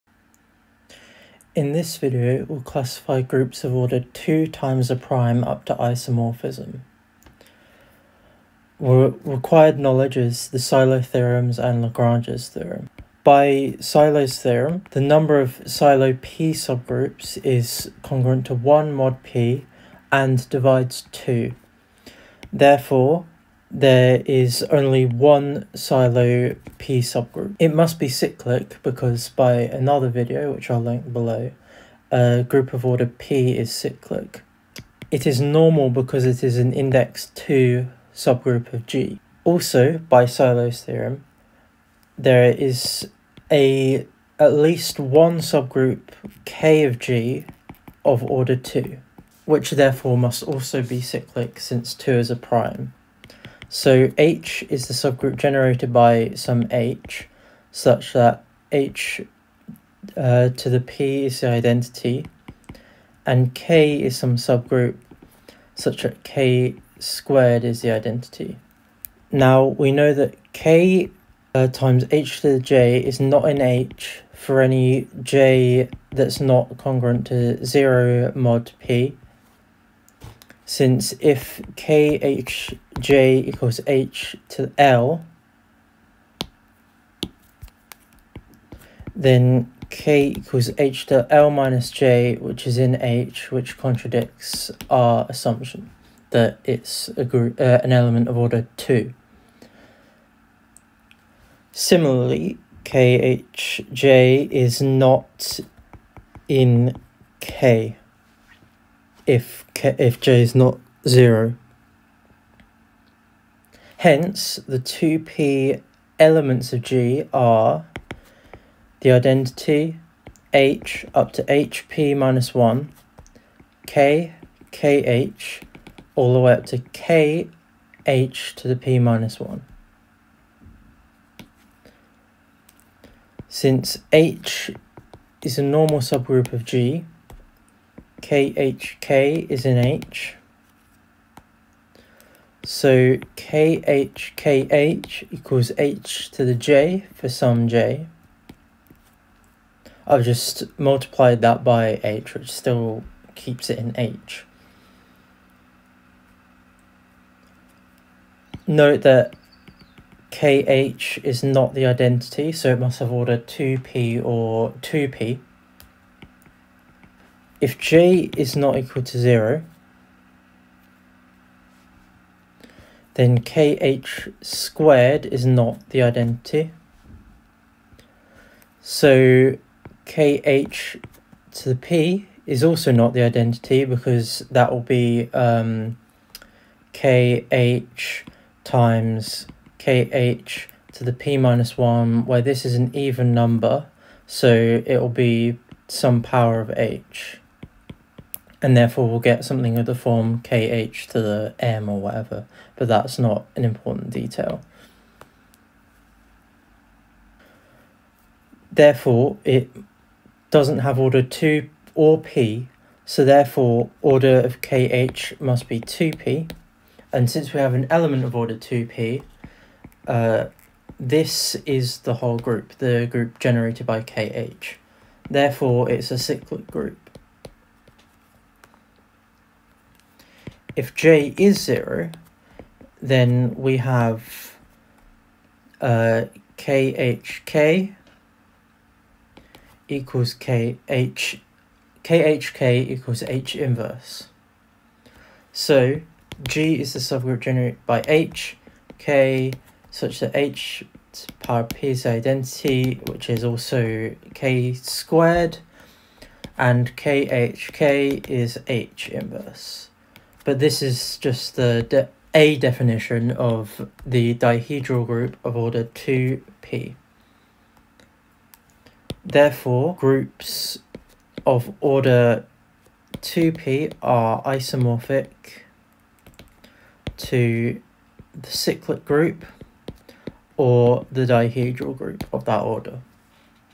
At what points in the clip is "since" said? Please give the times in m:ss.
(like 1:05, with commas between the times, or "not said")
0:51, 1:20, 2:13, 3:37.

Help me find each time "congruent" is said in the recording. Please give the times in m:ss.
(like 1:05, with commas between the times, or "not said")
0:18, 1:16.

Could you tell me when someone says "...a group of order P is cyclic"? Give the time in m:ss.
0:32.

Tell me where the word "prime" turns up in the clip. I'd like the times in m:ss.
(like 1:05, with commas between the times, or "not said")
0:04, 0:52.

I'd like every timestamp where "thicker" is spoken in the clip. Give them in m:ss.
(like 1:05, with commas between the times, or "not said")
not said.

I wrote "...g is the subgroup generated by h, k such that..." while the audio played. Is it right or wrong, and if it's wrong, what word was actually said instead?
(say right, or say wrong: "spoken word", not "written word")
right.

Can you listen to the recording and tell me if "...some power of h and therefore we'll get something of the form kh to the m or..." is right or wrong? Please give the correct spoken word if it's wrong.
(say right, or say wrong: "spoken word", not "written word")
right.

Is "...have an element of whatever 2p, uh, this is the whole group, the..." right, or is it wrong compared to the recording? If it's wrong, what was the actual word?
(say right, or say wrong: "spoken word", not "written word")
wrong: "order", not "whatever".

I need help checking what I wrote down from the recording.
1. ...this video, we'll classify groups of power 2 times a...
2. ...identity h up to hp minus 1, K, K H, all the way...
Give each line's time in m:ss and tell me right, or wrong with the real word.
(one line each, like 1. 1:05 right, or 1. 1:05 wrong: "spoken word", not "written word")
1. 0:01 wrong: "order", not "power"
2. 1:59 right.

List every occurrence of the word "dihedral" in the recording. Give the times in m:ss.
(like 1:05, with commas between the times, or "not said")
4:24, 4:41.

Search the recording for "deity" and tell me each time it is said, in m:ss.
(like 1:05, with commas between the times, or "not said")
not said.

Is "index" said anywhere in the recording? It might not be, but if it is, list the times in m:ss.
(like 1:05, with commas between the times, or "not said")
0:36.